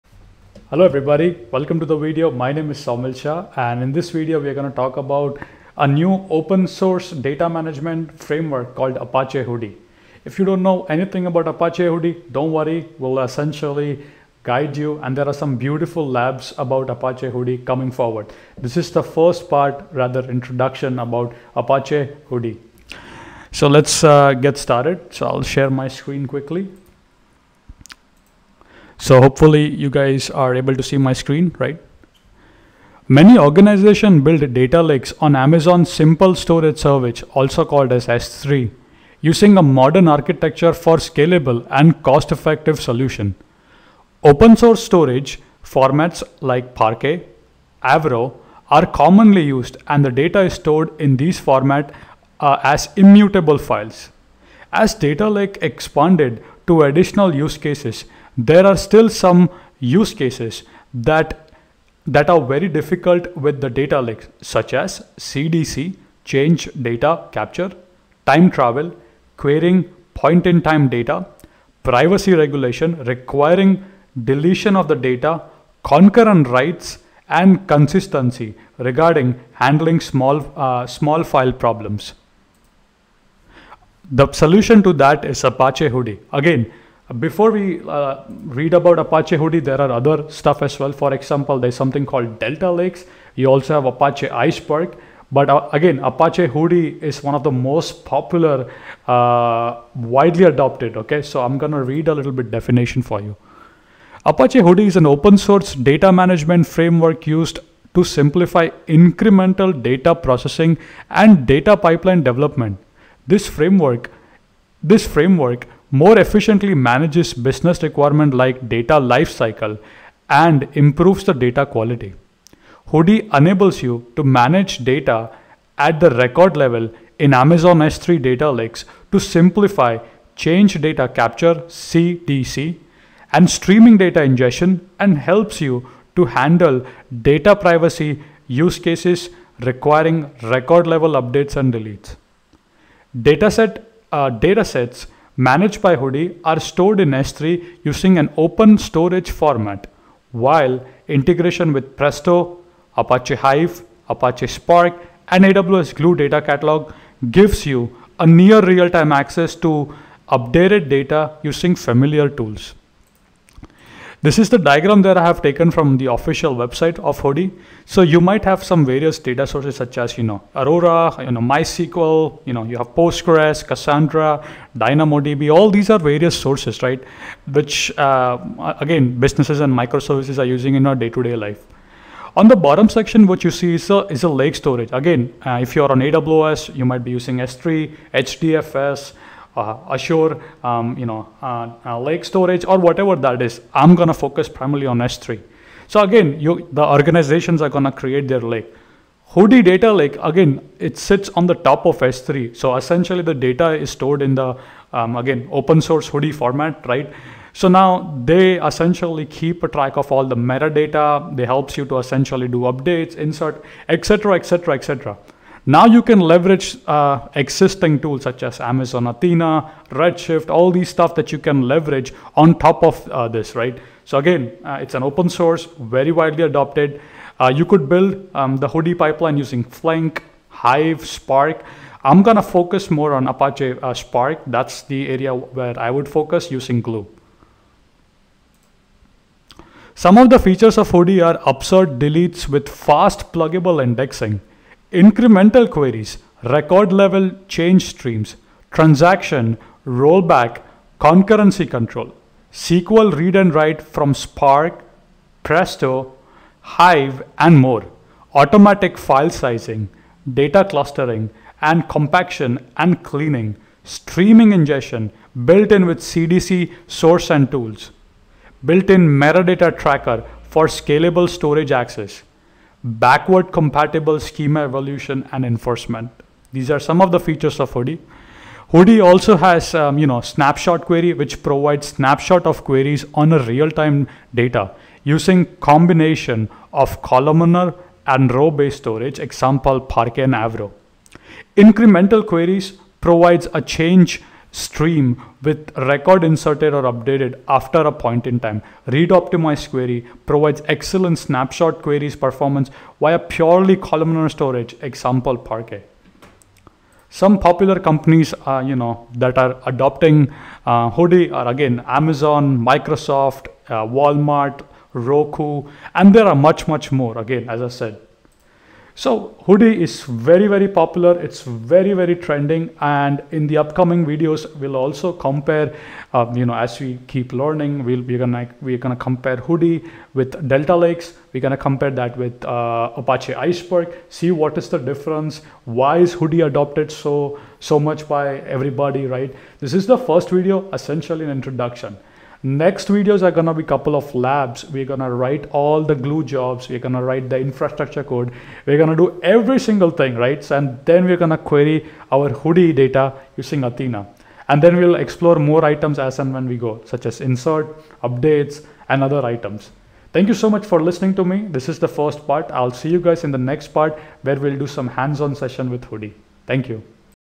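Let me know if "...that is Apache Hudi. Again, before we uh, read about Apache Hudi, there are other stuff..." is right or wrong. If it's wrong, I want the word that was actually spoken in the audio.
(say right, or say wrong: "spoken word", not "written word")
right.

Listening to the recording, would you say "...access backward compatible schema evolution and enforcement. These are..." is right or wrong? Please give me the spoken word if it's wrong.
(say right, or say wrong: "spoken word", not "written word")
right.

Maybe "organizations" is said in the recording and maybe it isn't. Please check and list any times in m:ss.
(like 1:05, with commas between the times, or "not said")
0:33, 3:16.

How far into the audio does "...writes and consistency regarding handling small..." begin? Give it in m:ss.
1:16.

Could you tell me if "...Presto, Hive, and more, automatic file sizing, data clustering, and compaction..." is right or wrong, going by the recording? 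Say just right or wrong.
right.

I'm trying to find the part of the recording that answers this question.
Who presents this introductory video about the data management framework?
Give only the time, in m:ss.
0:02.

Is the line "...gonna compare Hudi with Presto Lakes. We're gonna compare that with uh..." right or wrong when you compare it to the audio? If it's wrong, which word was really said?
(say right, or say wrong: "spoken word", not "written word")
wrong: "Delta", not "Presto".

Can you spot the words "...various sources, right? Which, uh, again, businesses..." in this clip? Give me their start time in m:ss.
2:55.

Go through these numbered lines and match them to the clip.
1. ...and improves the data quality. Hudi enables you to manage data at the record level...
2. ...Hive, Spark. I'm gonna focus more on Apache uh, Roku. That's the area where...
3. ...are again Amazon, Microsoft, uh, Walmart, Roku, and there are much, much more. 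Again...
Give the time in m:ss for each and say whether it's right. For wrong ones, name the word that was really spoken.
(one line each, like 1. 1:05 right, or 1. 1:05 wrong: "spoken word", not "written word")
1. 2:00 right
2. 3:50 wrong: "Spark", not "Roku"
3. 5:11 right.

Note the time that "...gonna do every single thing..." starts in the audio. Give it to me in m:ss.
5:48.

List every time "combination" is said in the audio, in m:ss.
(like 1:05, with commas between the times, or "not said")
4:45.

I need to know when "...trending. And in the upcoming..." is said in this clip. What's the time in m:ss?
5:22.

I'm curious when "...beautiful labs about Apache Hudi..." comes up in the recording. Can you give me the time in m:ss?
0:15.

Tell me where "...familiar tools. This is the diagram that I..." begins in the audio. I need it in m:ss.
2:41.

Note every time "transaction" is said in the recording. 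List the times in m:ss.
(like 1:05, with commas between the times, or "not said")
4:08.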